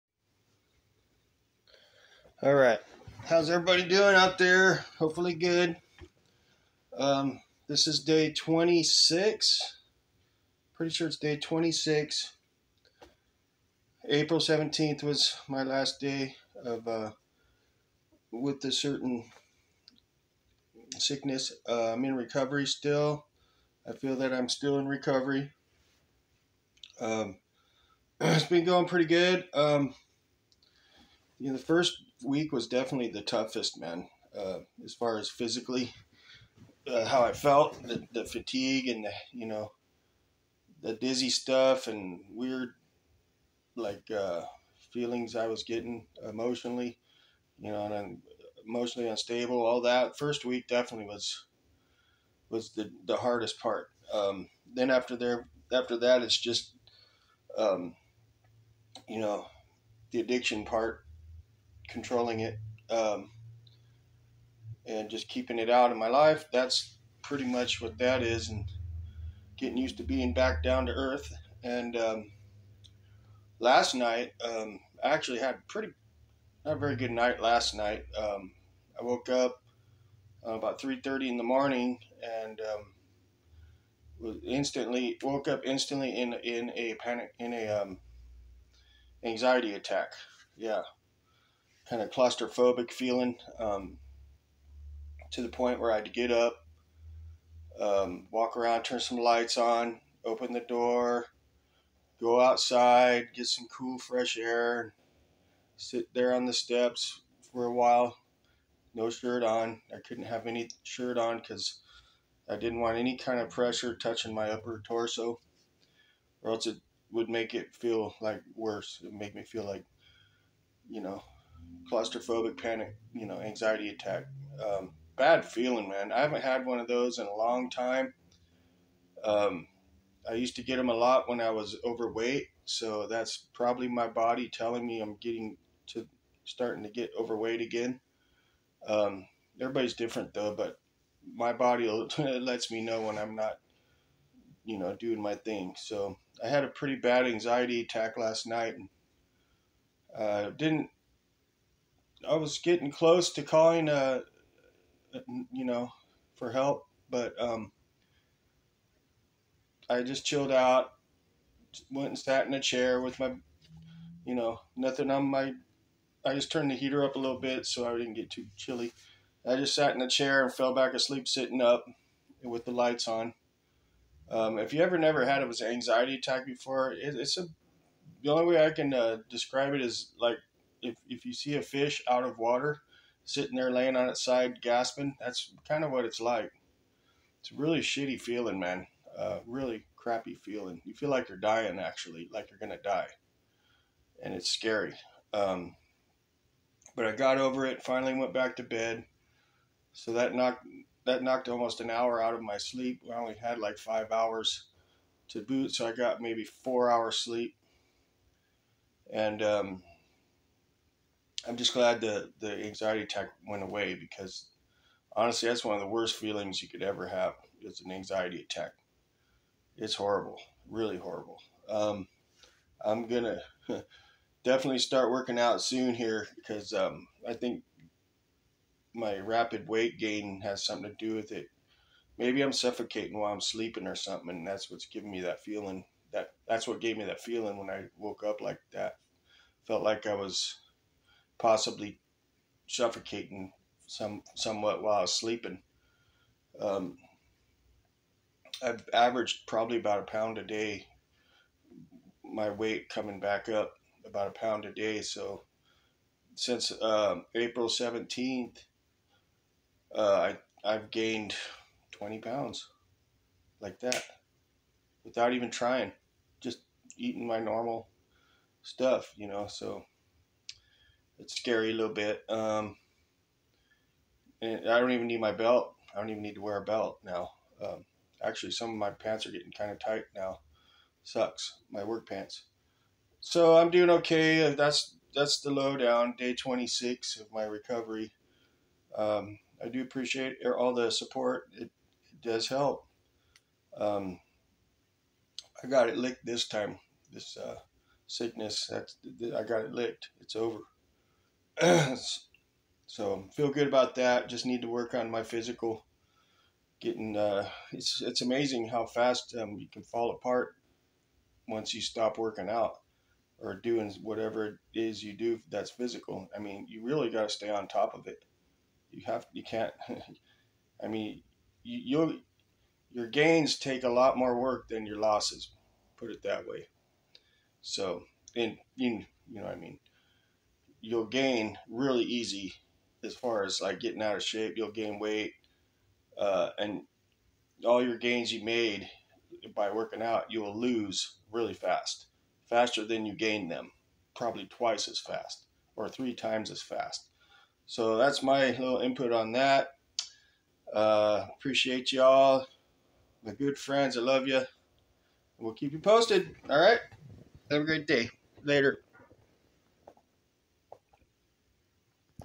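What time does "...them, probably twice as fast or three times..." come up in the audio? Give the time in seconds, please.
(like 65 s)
343 s.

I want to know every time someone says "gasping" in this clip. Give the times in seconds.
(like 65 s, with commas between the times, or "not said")
184 s.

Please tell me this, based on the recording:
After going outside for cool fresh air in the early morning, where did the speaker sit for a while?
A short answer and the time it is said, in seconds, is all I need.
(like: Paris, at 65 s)
the steps, at 106 s.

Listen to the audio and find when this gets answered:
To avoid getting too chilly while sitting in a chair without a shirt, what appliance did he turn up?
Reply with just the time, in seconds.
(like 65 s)
166 s.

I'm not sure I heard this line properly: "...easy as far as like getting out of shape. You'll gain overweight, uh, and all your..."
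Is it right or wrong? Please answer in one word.
wrong.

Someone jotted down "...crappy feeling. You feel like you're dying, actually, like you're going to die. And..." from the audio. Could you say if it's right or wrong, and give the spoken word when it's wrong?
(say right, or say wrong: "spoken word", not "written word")
right.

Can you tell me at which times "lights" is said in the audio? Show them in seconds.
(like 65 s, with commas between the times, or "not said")
99 s, 172 s.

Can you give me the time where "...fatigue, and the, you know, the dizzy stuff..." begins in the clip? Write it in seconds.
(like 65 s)
38 s.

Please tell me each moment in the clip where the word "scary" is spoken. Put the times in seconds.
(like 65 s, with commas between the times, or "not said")
194 s, 271 s.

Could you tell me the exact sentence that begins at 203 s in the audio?
I only had like five hours to boot, so I got maybe four hours sleep.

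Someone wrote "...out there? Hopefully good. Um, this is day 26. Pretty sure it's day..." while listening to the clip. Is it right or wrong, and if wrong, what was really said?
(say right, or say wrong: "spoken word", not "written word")
right.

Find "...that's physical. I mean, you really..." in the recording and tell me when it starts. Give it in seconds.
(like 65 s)
315 s.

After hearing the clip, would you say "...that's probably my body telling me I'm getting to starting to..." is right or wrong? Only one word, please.
right.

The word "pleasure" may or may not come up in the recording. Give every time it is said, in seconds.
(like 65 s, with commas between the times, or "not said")
not said.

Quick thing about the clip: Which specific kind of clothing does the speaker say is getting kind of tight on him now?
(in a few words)
work pants.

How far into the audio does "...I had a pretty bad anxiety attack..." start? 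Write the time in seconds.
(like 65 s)
146 s.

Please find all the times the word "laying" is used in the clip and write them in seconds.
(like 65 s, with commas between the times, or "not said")
183 s.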